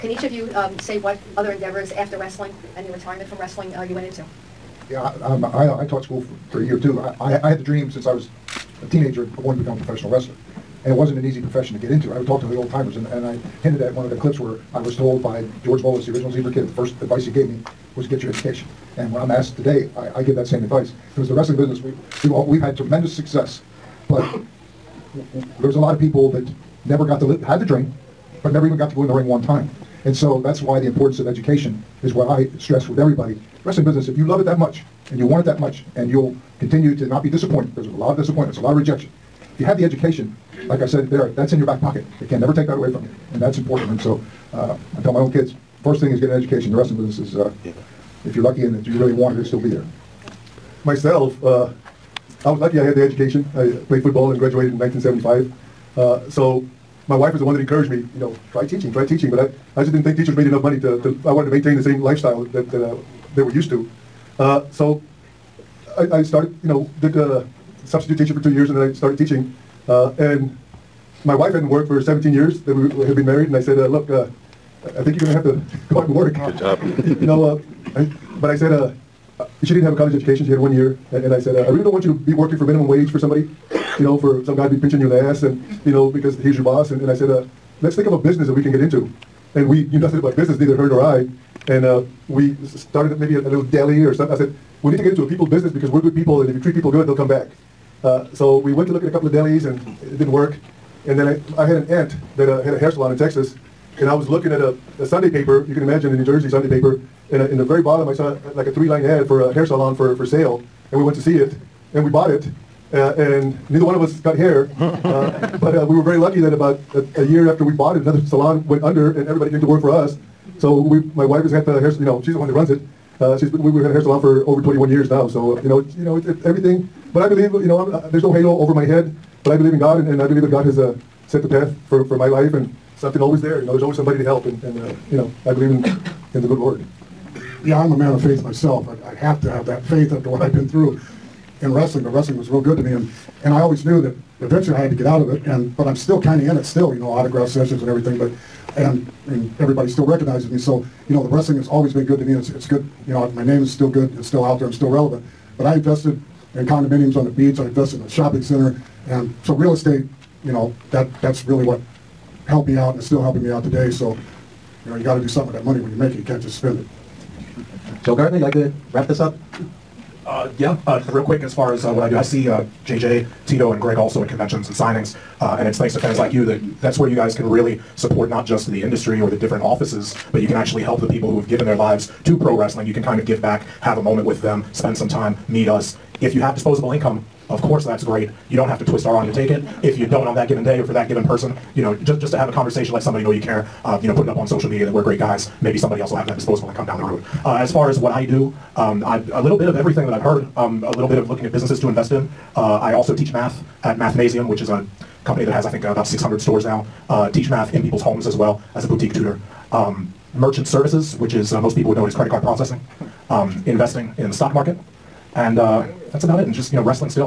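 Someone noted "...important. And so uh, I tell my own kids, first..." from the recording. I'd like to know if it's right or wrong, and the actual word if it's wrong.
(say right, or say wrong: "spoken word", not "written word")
right.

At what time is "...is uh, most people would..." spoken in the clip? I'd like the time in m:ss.
3:31.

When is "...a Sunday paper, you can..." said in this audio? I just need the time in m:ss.
1:45.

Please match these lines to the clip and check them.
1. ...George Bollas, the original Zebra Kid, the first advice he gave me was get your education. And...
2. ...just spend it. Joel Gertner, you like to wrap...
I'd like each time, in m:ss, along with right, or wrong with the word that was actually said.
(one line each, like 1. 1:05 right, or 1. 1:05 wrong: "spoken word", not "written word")
1. 0:15 right
2. 2:46 right.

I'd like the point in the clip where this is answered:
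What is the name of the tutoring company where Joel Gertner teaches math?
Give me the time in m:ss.
3:23.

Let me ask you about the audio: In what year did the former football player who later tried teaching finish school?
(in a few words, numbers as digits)
1975.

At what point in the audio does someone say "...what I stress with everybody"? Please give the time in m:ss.
0:32.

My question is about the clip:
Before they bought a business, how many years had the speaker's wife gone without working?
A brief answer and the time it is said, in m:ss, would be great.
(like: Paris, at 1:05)
17, at 1:12.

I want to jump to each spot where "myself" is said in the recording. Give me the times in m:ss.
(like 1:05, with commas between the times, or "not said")
0:50, 2:18.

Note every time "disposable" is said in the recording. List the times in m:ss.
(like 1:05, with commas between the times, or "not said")
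3:06, 3:16.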